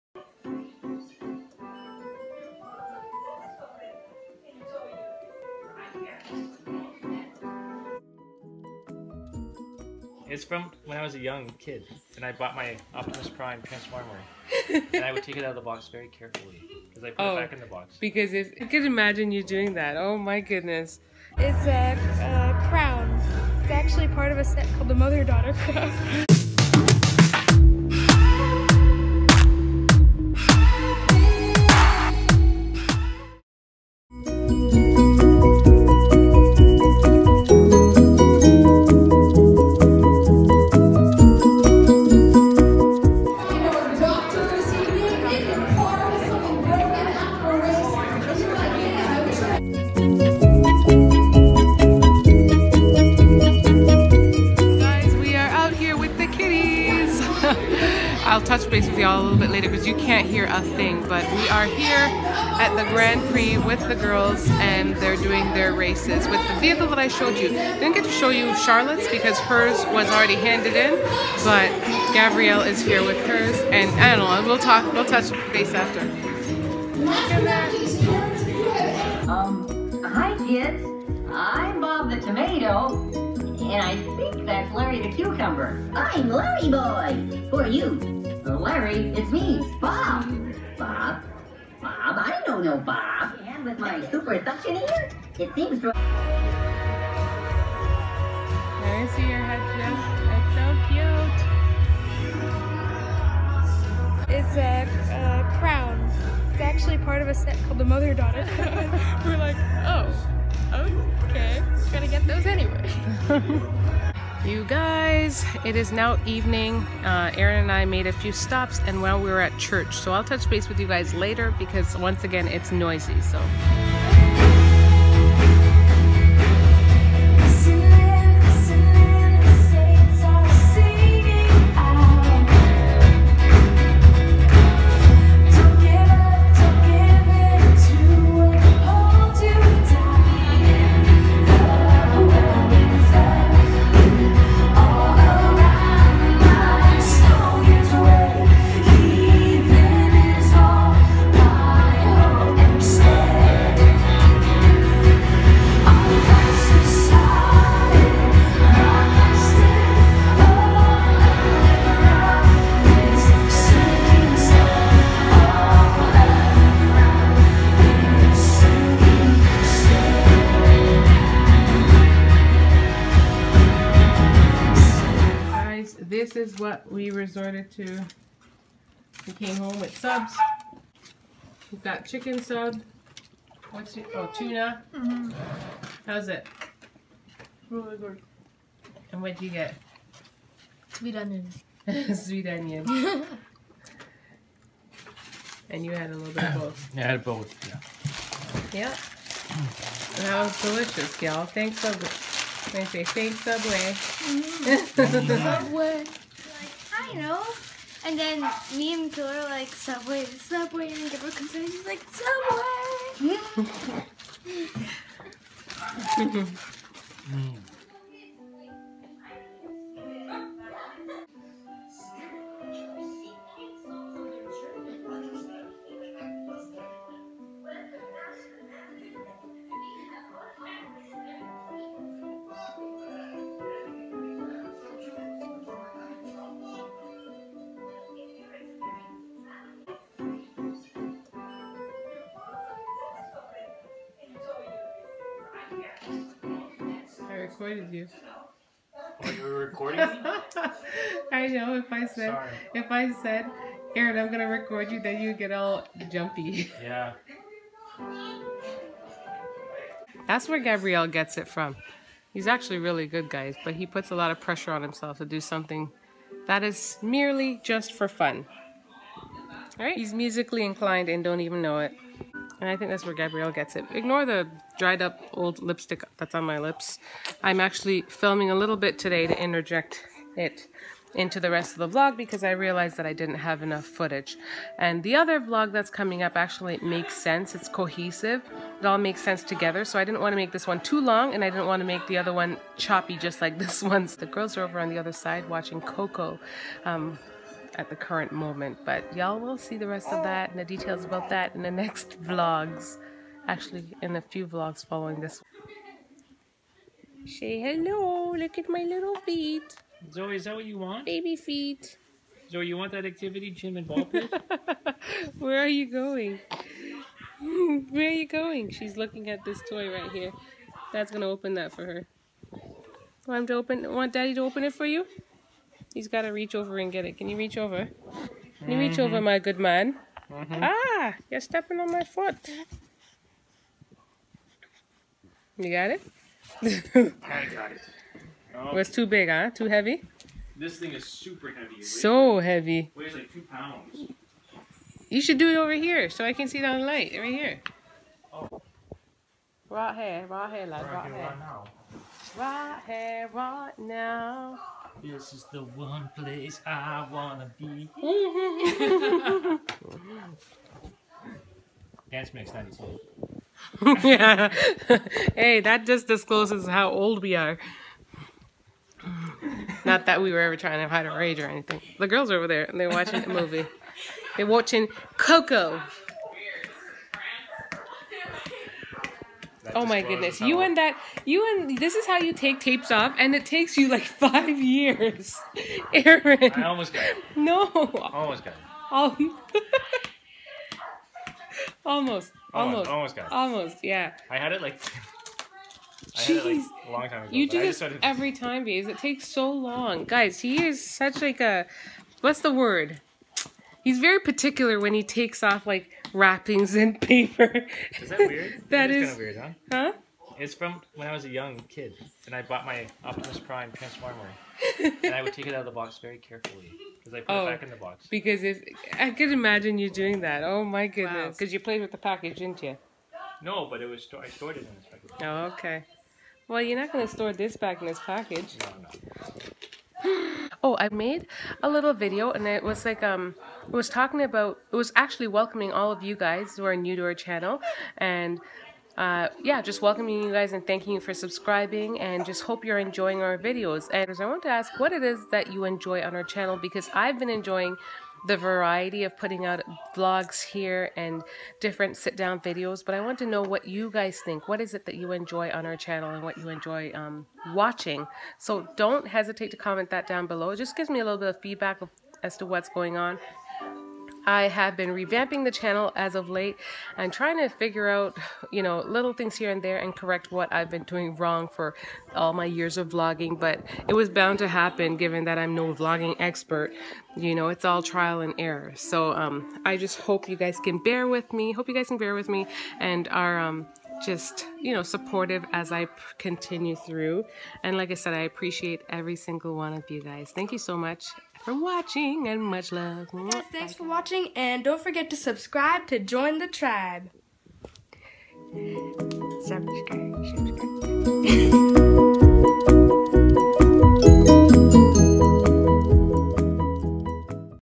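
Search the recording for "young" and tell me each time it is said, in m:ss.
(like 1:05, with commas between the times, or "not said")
0:11, 6:51.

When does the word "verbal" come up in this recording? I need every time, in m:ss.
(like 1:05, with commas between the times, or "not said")
not said.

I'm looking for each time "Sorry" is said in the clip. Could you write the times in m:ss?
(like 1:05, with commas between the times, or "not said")
4:12.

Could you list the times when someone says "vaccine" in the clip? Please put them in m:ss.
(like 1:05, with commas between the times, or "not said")
not said.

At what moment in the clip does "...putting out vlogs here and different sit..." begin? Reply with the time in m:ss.
7:29.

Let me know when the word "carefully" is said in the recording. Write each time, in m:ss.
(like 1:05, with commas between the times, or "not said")
0:16, 6:56.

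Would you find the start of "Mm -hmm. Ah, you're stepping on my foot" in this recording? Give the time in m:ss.
5:30.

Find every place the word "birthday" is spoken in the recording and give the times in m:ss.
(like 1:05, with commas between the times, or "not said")
not said.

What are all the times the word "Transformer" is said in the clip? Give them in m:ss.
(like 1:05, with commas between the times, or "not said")
0:13, 6:53.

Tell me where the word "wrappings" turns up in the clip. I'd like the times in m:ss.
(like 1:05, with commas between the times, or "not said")
6:46.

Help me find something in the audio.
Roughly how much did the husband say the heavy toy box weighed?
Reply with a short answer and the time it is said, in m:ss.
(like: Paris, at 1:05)
2 pounds, at 5:43.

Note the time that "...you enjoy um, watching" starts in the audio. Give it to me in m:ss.
7:36.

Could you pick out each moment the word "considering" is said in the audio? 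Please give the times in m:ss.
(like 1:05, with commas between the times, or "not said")
not said.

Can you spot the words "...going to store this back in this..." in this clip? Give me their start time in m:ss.
7:06.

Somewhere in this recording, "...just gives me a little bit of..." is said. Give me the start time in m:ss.
7:40.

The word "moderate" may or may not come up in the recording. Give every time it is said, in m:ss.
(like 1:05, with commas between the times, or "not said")
not said.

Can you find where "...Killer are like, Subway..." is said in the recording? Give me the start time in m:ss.
3:29.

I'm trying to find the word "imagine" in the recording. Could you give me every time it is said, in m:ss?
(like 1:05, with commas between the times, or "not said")
0:18, 6:59.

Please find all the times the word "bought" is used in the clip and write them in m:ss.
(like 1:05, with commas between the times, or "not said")
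0:12, 6:52.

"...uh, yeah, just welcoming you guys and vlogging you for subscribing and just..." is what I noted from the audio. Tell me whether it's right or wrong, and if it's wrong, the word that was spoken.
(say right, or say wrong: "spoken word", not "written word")
wrong: "thanking", not "vlogging".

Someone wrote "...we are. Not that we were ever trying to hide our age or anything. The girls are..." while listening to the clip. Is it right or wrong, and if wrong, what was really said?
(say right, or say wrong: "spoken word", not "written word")
right.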